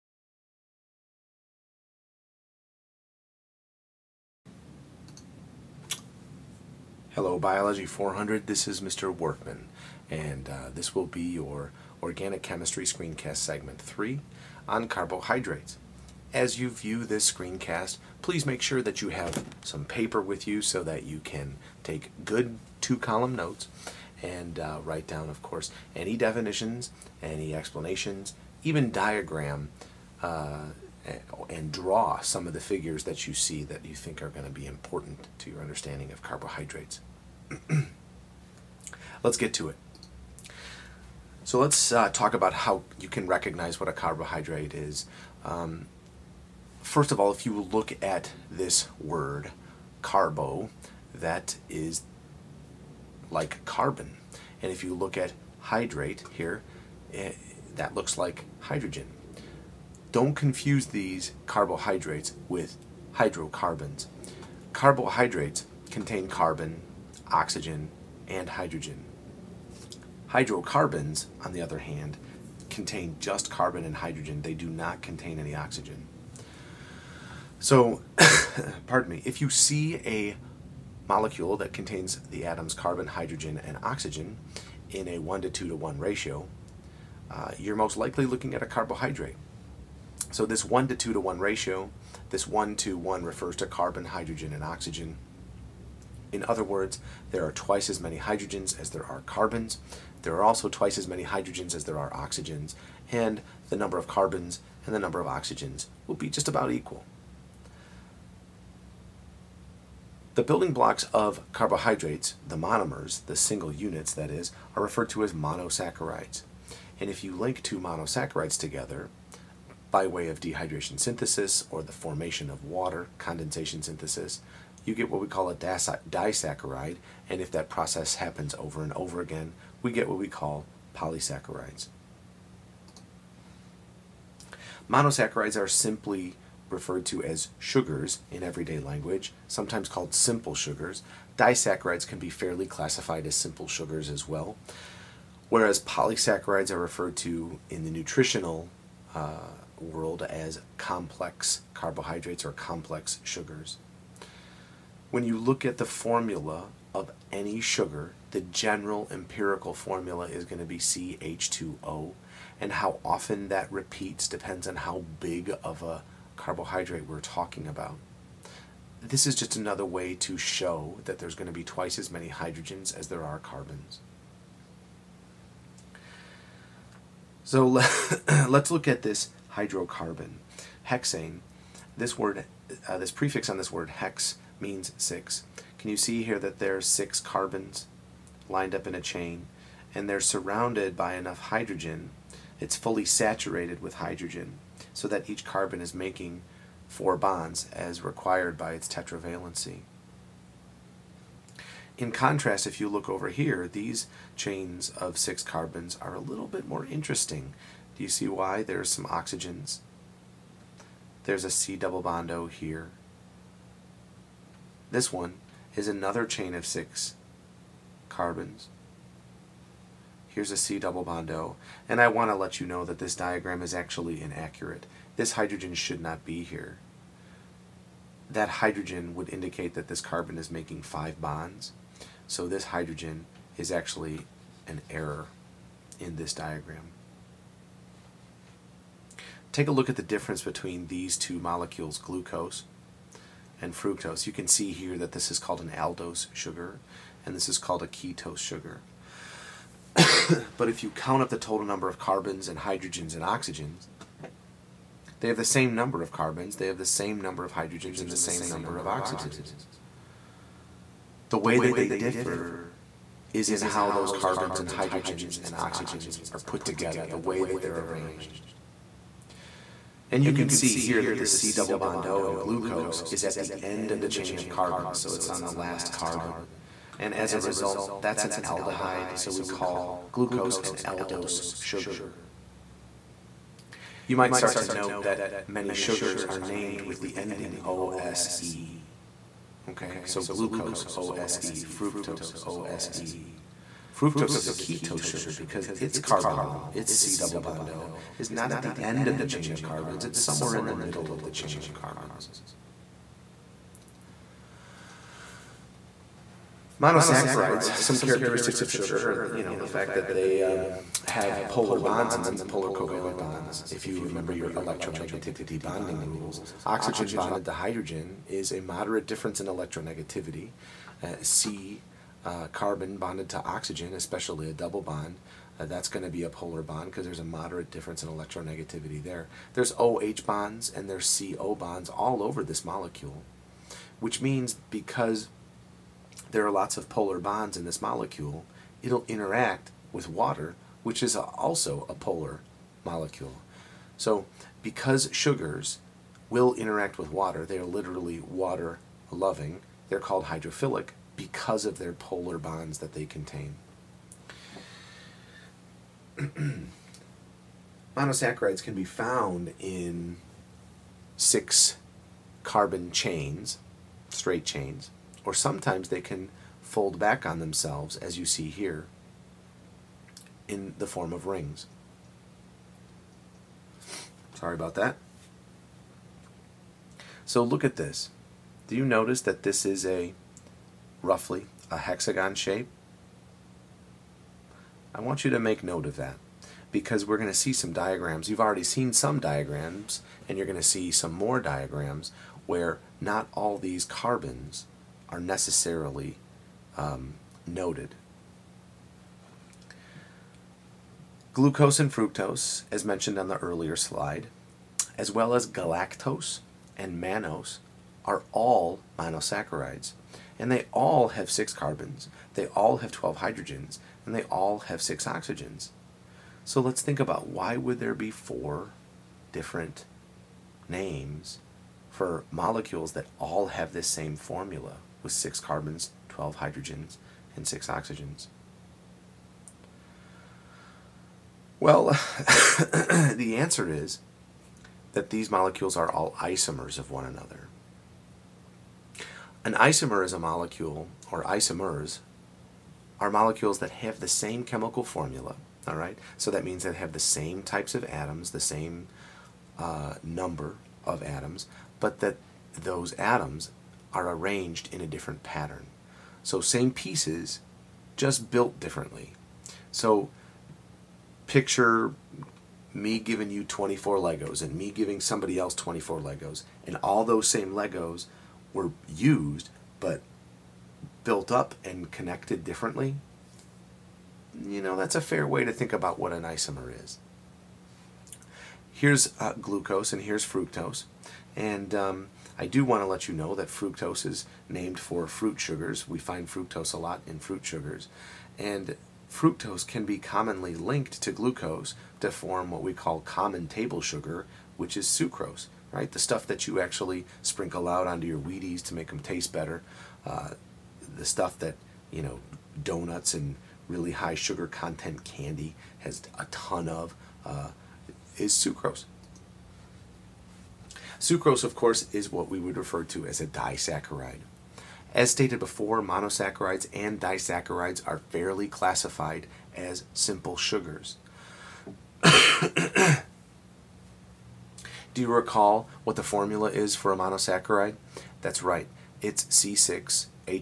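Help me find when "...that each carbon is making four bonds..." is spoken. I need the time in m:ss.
3:15.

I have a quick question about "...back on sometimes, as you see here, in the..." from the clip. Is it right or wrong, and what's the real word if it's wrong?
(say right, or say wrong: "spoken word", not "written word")
wrong: "themselves", not "sometimes".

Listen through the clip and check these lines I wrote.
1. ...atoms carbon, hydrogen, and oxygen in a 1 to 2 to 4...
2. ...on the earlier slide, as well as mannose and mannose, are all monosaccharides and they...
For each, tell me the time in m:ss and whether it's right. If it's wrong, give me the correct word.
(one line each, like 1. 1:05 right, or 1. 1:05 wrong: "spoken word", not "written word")
1. 1:22 wrong: "1", not "4"
2. 6:43 wrong: "galactose", not "mannose".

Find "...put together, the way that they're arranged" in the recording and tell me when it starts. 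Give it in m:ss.
4:26.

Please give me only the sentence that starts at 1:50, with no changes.
The building blocks of carbohydrates, the monomers, the single units that is, are referred to as monosaccharides.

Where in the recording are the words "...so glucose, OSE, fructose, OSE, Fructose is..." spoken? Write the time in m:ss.
4:50.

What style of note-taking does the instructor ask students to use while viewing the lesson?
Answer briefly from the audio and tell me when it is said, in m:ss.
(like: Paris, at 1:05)
two-column notes, at 0:22.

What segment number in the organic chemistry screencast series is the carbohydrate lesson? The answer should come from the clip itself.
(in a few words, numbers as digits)
3.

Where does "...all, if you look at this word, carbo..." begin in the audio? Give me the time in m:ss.
0:47.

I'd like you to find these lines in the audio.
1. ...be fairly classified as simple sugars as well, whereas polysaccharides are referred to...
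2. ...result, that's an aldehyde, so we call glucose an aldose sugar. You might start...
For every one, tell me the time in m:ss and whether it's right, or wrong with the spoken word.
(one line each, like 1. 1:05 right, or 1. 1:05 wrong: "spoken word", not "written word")
1. 2:22 right
2. 4:37 right.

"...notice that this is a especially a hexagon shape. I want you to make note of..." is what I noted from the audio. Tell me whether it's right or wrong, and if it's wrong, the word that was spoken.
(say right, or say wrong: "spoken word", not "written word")
wrong: "roughly", not "especially".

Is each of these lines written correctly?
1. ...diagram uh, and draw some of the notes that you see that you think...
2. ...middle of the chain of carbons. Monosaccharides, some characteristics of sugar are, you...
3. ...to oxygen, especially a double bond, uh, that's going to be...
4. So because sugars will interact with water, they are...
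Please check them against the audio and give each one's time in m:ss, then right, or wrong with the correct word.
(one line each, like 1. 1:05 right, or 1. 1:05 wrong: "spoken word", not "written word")
1. 0:28 wrong: "figures", not "notes"
2. 5:00 right
3. 5:23 right
4. 5:43 right.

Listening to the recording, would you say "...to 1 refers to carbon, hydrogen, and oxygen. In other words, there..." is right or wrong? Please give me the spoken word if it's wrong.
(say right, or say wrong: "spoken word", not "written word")
right.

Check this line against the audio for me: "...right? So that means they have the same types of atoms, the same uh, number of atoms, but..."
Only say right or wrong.
right.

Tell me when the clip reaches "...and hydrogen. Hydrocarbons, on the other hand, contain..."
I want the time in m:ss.
1:08.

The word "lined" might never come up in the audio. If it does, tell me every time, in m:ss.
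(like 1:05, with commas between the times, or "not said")
3:08.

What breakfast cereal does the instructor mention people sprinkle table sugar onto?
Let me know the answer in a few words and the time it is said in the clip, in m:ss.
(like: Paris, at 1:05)
Wheaties, at 8:18.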